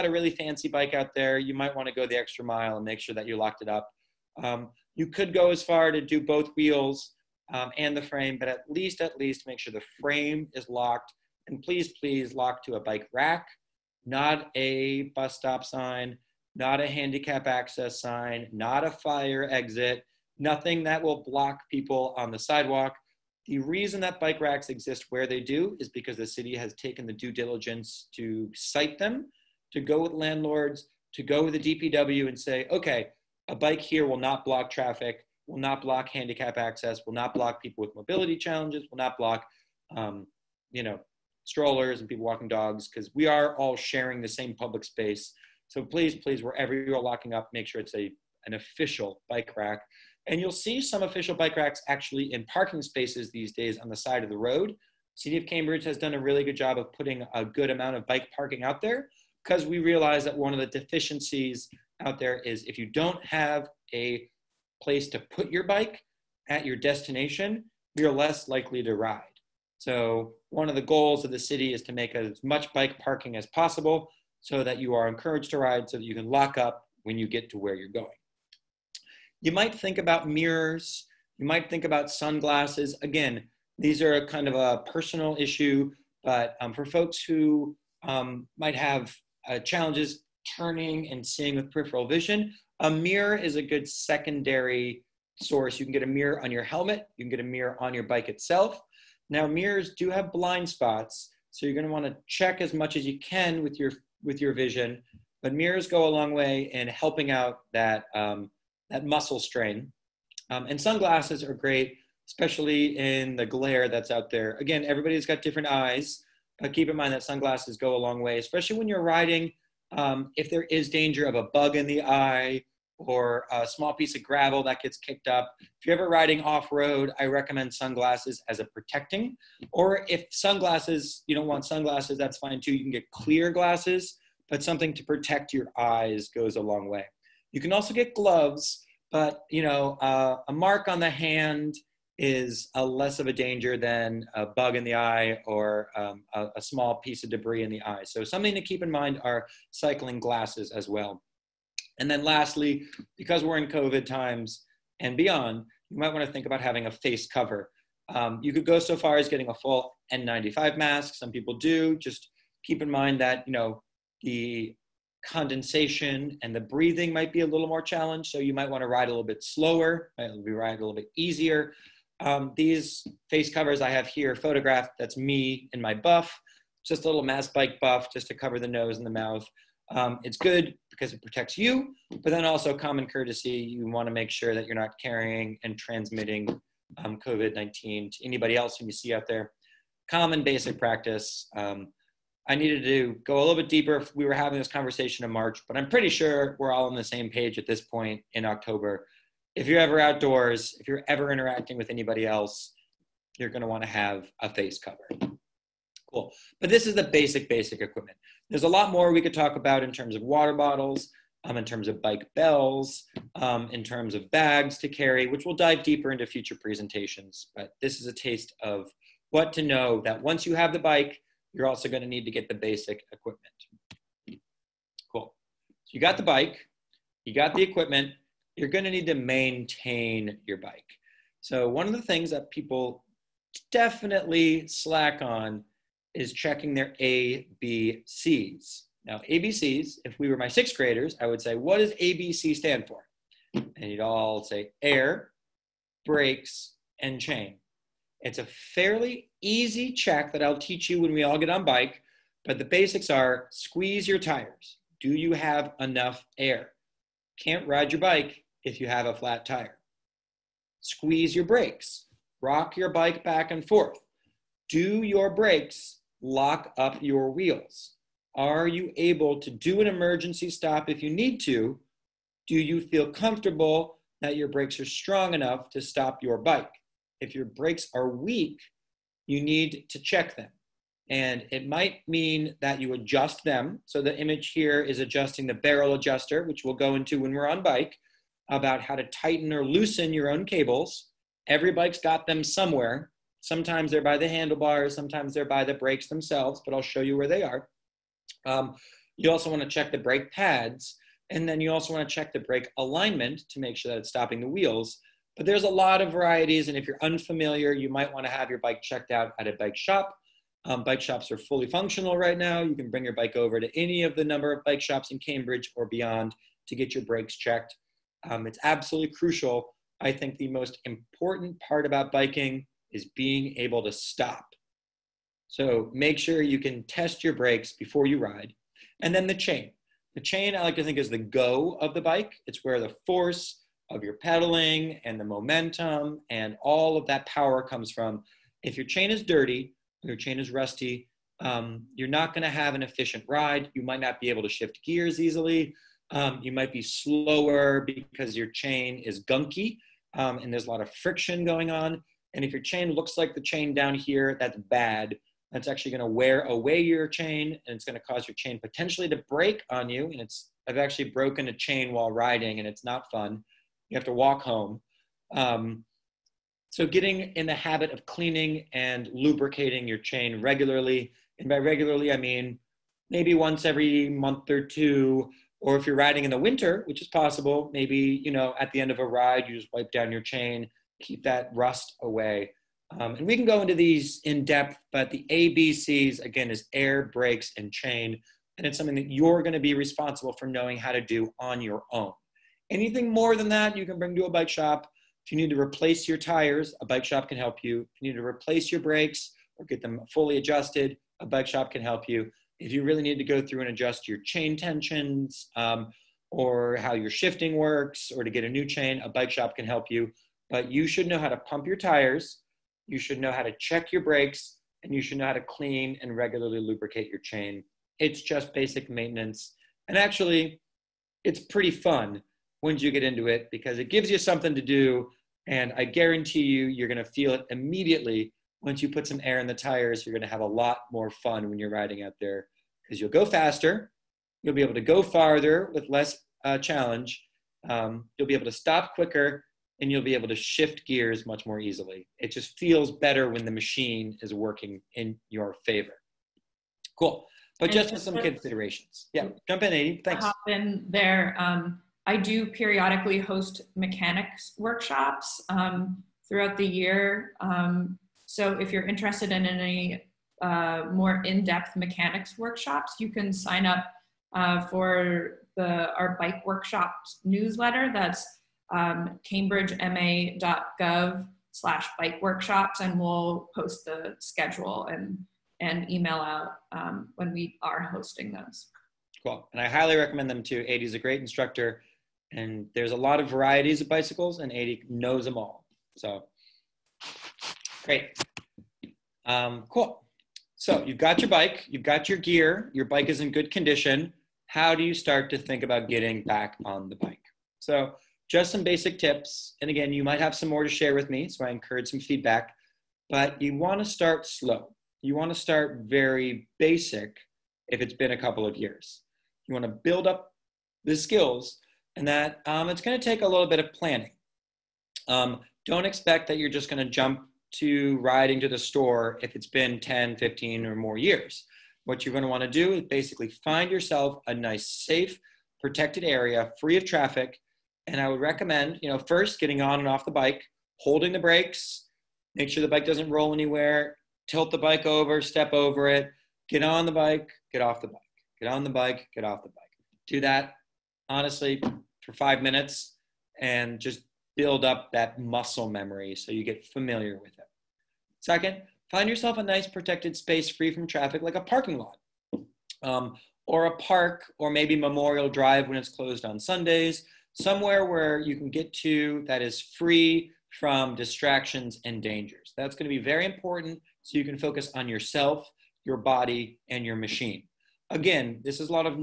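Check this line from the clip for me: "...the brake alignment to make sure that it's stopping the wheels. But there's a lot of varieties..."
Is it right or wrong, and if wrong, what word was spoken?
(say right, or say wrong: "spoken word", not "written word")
right.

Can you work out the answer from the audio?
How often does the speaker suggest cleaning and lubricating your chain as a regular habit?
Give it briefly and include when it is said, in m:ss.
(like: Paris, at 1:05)
once every month or two, at 6:13.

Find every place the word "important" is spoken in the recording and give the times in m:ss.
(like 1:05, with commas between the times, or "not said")
5:20, 9:23.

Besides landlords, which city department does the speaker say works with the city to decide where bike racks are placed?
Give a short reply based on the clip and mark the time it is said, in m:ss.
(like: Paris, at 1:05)
DPW, at 0:31.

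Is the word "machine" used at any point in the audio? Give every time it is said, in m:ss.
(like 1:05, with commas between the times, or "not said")
7:23, 9:26.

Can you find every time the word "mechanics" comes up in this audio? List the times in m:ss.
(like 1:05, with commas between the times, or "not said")
7:33, 7:41.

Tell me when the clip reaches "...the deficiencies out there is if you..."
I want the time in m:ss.
1:00.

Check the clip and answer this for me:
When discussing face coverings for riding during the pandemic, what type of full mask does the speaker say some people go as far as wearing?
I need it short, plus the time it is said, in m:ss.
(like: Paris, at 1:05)
N95, at 2:40.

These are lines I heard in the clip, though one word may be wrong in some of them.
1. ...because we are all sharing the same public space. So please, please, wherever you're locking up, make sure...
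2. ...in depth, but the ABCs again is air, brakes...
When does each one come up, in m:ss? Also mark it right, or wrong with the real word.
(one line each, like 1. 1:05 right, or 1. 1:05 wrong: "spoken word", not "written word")
1. 0:42 right
2. 6:24 right.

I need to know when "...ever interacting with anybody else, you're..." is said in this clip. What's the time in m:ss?
3:21.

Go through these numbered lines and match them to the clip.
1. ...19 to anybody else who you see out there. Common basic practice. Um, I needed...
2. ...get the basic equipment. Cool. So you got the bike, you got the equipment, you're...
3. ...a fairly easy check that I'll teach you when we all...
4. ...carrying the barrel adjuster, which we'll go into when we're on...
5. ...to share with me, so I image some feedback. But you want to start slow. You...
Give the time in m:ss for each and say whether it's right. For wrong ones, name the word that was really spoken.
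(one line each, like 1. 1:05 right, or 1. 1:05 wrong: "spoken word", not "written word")
1. 3:07 right
2. 3:42 right
3. 4:08 right
4. 4:44 wrong: "adjusting", not "carrying"
5. 8:20 wrong: "encourage", not "image".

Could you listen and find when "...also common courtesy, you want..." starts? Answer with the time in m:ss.
3:02.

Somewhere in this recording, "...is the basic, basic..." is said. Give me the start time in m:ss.
3:26.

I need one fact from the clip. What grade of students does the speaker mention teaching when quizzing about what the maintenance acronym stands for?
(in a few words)
sixth graders.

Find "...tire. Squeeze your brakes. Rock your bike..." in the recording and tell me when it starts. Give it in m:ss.
4:19.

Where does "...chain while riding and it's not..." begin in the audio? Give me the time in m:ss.
6:01.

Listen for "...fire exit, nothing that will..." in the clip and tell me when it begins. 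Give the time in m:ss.
0:18.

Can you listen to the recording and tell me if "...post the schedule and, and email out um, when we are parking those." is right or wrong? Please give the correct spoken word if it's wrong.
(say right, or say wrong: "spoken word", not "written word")
wrong: "hosting", not "parking".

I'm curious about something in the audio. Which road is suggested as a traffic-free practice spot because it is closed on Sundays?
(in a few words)
Memorial Drive.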